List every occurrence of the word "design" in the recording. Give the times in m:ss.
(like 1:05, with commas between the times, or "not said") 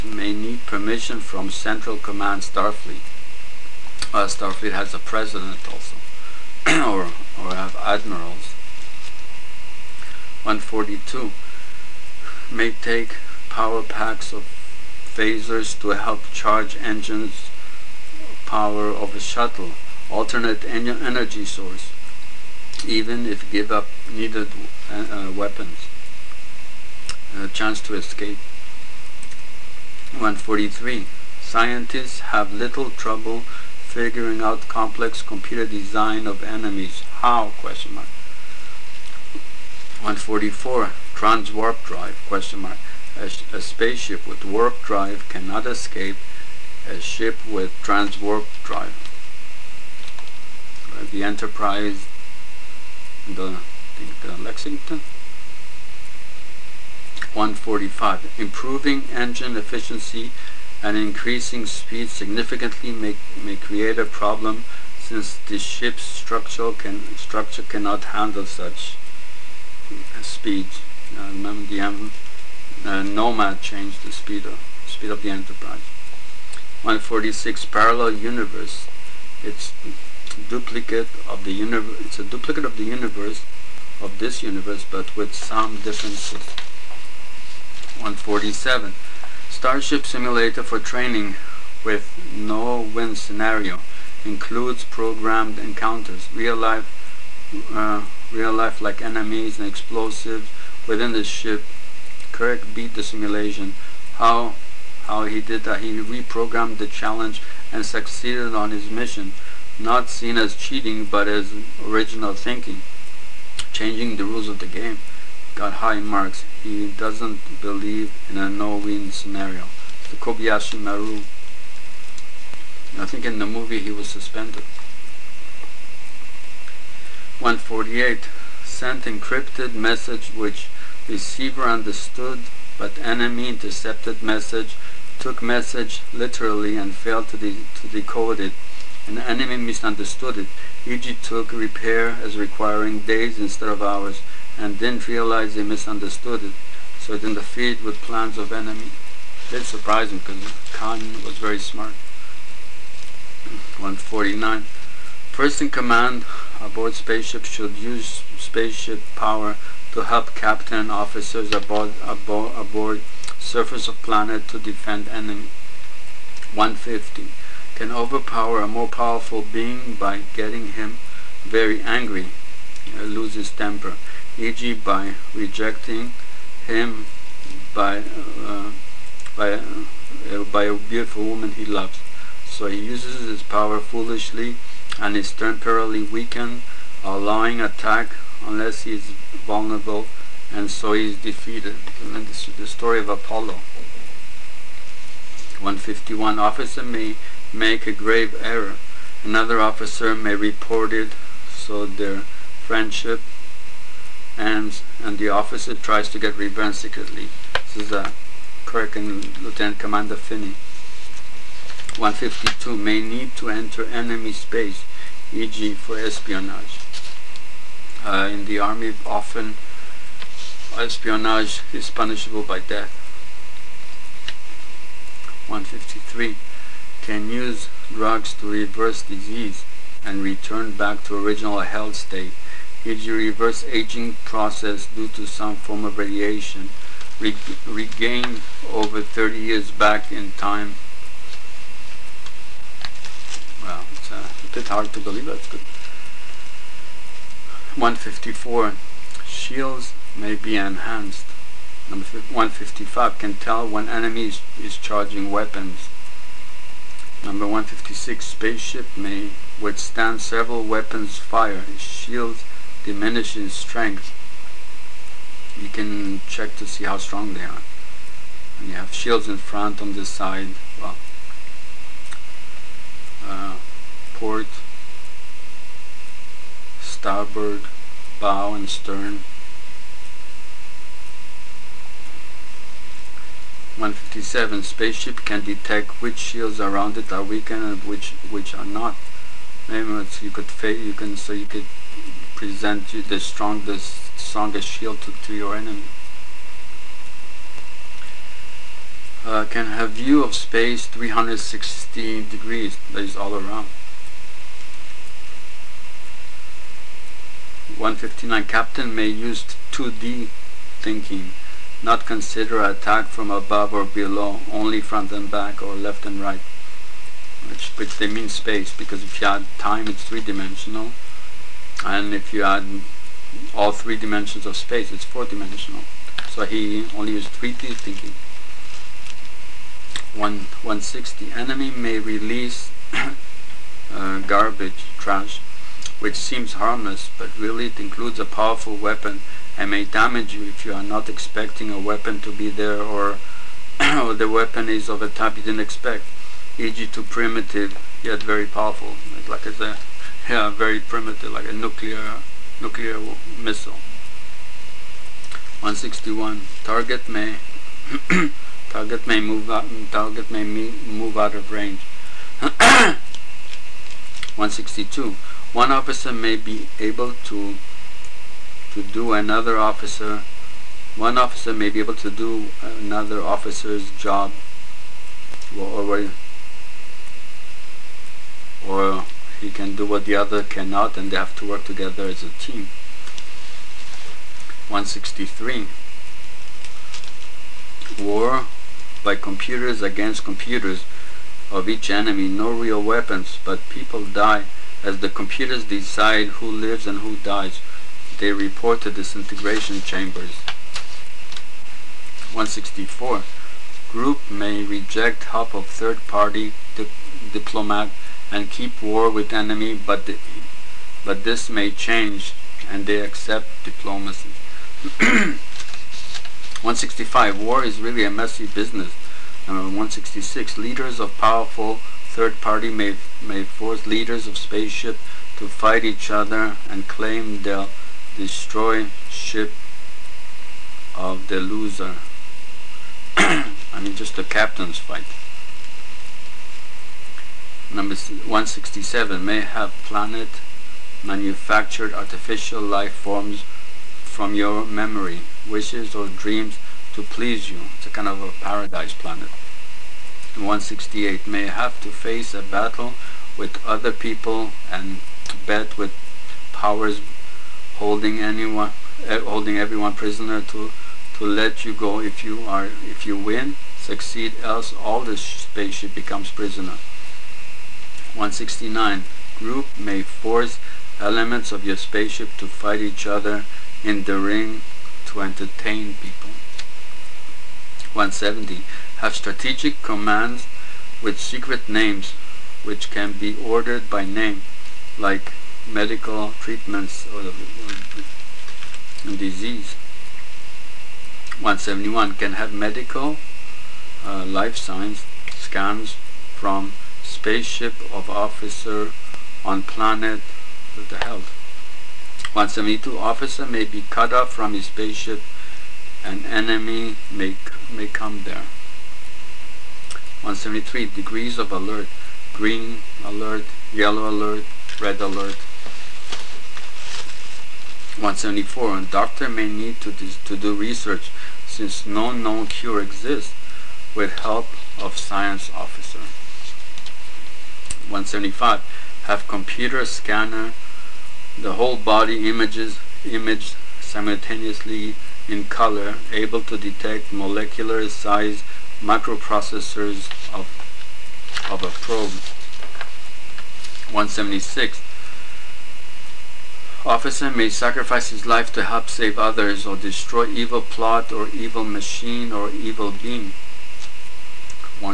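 0:35.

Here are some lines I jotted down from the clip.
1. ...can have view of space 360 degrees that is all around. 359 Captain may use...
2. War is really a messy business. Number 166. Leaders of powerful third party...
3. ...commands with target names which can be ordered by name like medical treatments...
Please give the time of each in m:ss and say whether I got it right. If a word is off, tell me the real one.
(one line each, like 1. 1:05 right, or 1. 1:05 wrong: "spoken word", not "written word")
1. 4:59 wrong: "159", not "359"
2. 6:57 right
3. 7:59 wrong: "secret", not "target".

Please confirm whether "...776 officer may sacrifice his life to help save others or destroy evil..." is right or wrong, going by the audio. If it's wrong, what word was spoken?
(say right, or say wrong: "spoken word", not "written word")
wrong: "176", not "776".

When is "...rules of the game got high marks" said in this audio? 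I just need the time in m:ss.
1:54.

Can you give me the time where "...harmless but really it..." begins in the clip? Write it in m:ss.
5:36.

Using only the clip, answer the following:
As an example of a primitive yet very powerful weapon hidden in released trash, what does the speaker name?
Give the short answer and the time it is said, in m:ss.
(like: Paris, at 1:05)
nuclear missile, at 5:52.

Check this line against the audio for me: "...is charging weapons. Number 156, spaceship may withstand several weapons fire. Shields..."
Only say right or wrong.
right.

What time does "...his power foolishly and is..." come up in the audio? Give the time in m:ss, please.
3:03.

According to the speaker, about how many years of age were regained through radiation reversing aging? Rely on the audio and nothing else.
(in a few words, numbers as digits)
30.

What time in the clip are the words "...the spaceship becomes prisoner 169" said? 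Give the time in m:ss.
7:45.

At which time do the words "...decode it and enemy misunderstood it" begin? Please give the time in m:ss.
2:17.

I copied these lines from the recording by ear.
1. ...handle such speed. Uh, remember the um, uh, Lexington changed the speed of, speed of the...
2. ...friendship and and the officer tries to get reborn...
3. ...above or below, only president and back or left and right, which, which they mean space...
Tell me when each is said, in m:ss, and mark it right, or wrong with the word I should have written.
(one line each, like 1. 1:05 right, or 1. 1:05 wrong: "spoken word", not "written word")
1. 1:08 wrong: "Nomad", not "Lexington"
2. 3:22 right
3. 5:13 wrong: "front", not "president".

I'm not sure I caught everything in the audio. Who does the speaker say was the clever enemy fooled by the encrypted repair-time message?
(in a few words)
Khan.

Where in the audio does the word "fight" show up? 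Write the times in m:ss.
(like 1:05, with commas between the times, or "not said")
7:05, 7:14, 7:52.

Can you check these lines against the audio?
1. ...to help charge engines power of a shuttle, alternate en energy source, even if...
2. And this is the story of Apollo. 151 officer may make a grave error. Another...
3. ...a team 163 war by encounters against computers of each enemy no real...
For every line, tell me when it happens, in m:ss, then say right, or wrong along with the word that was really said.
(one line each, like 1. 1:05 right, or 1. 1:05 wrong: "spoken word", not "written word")
1. 0:15 right
2. 3:12 right
3. 6:22 wrong: "computers", not "encounters".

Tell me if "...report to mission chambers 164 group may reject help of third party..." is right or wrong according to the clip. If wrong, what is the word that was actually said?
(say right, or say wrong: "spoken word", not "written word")
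wrong: "disintegration", not "mission".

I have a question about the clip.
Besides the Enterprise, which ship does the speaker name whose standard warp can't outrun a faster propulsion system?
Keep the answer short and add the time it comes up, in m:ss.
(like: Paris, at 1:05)
Lexington, at 0:54.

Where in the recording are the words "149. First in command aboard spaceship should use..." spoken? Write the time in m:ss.
2:33.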